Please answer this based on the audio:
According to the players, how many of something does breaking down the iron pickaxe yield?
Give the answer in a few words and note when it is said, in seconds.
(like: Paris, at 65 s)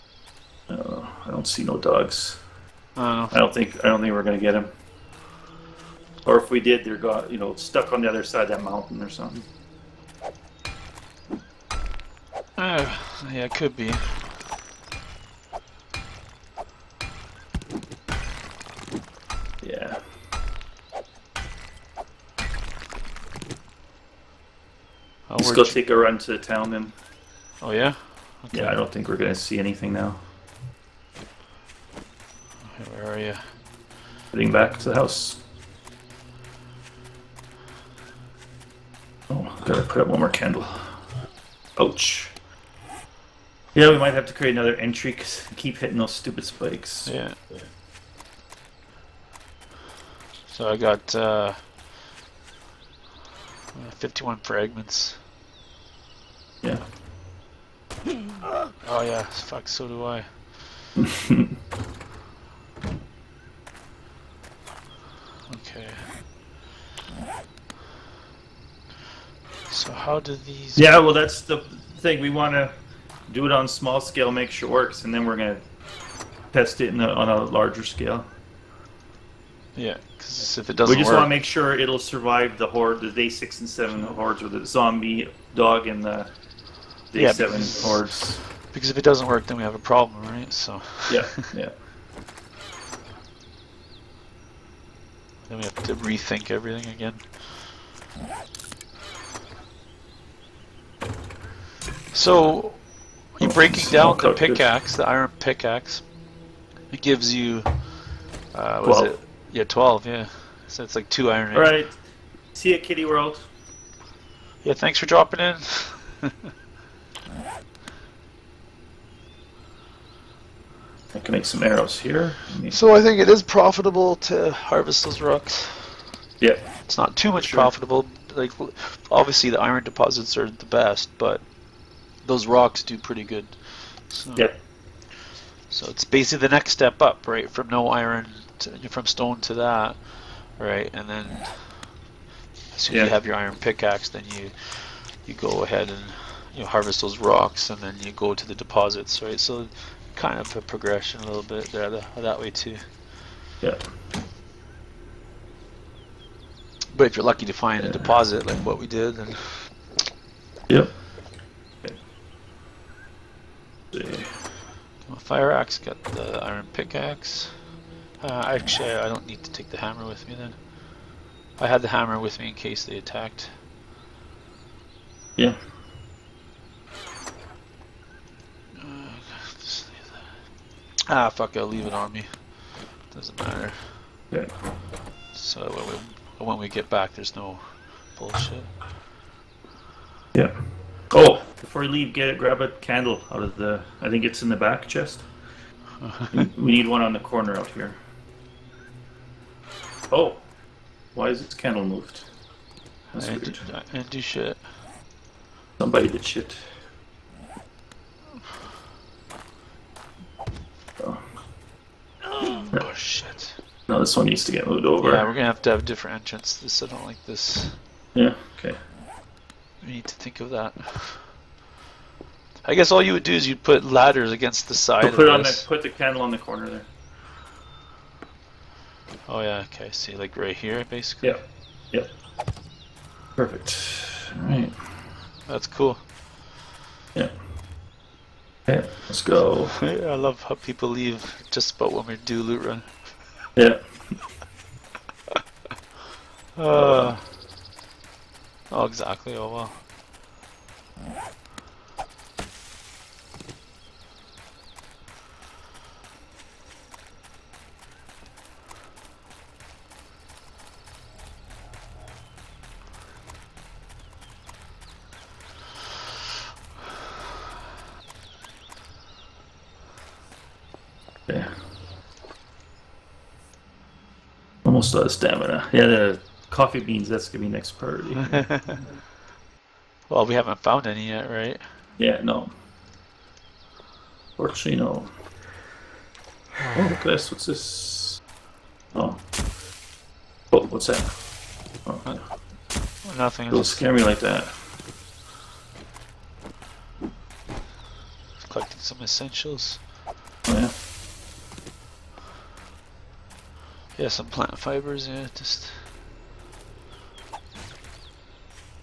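12, at 109 s.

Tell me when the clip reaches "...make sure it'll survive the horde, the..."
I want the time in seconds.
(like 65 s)
81 s.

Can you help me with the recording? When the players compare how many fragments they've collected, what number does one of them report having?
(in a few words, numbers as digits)
51.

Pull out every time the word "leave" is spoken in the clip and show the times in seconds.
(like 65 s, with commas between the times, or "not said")
181 s, 191 s, 240 s.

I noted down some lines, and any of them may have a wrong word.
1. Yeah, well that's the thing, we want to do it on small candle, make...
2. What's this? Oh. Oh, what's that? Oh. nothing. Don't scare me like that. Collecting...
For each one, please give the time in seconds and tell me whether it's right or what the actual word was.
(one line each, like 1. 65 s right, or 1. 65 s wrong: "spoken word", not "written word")
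1. 70 s wrong: "scale", not "candle"
2. 287 s right.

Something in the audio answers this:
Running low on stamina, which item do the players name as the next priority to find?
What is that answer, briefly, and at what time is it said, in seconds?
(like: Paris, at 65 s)
coffee beans, at 276 s.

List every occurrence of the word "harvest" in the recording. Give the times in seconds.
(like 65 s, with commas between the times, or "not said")
124 s, 146 s.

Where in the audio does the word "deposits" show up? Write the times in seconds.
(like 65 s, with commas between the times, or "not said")
129 s, 148 s, 157 s.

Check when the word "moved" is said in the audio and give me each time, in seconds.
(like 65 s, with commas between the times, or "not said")
201 s, 214 s.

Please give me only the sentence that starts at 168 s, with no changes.
Uh, actually, I don't need to take the hammer with me then.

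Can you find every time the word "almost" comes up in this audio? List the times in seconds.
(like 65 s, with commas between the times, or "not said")
274 s.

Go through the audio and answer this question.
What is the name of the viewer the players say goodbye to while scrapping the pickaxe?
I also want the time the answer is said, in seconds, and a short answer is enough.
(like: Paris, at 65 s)
Kitty World, at 112 s.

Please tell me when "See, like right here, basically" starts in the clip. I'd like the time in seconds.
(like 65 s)
229 s.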